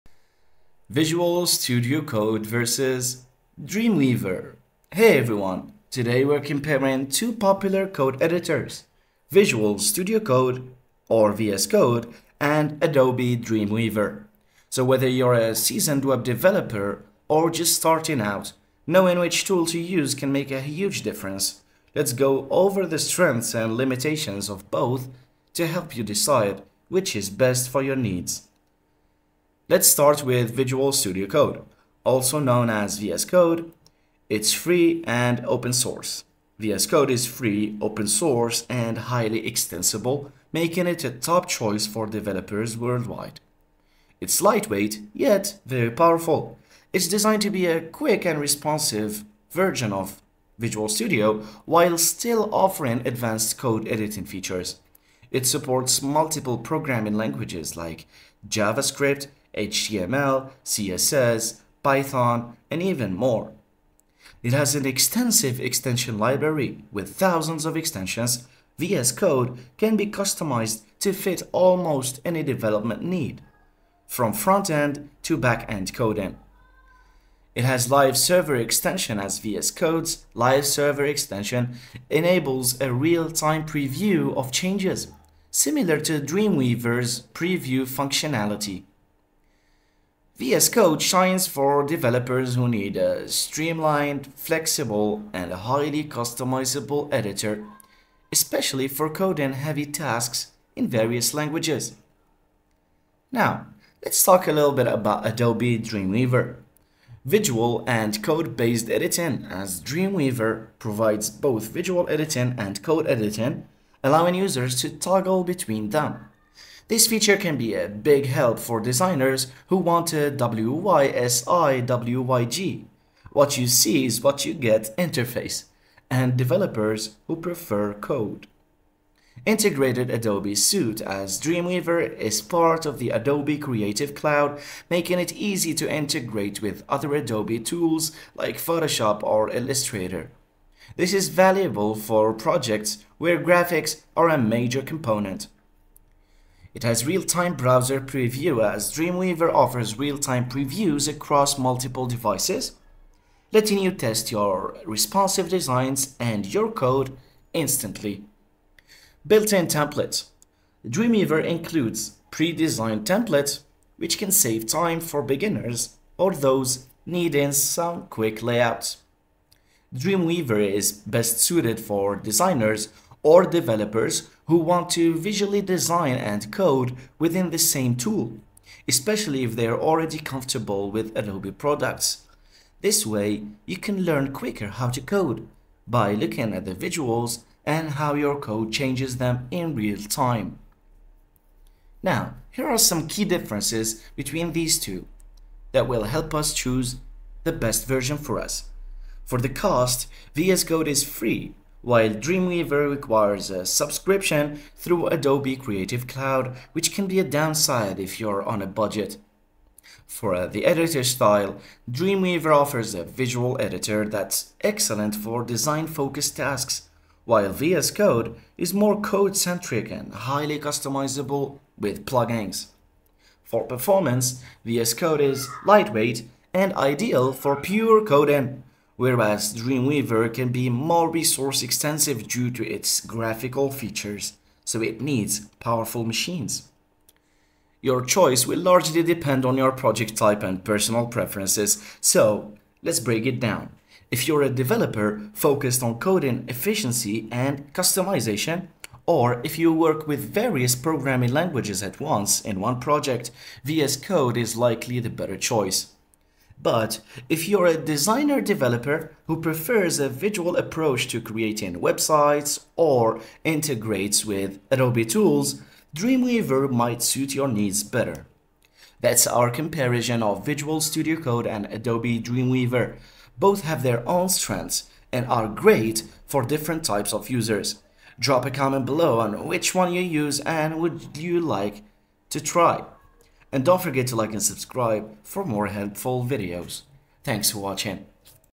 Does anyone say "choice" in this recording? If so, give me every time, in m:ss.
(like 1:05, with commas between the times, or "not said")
0:41, 3:58, 4:15.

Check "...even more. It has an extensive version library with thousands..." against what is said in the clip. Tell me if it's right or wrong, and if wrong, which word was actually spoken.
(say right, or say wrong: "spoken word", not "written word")
wrong: "extension", not "version".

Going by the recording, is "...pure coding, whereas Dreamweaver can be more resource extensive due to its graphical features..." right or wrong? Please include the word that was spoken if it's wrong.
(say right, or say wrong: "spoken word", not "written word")
right.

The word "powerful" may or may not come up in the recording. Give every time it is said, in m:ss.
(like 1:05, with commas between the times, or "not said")
0:45, 3:55.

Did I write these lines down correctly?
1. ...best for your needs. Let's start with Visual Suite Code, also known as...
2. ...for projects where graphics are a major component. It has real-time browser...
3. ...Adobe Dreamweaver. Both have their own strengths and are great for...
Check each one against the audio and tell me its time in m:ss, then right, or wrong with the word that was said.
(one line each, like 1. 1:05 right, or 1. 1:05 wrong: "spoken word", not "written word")
1. 0:27 wrong: "Studio", not "Suite"
2. 2:21 right
3. 4:31 right.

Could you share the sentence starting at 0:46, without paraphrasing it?
It's designed to be a quick and responsive version of Visual Studio while still offering advanced code editing features.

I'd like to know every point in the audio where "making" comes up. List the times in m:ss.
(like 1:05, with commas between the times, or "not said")
0:40, 2:14.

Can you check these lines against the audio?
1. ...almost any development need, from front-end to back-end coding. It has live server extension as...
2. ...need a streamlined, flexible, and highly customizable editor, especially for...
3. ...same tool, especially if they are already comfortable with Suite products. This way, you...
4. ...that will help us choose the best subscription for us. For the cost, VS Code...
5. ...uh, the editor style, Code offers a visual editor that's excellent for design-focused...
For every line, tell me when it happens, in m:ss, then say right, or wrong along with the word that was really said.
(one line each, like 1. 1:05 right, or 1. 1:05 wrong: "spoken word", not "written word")
1. 1:11 right
2. 1:32 right
3. 2:57 wrong: "Adobe", not "Suite"
4. 3:15 wrong: "version", not "subscription"
5. 3:30 wrong: "Dreamweaver", not "Code".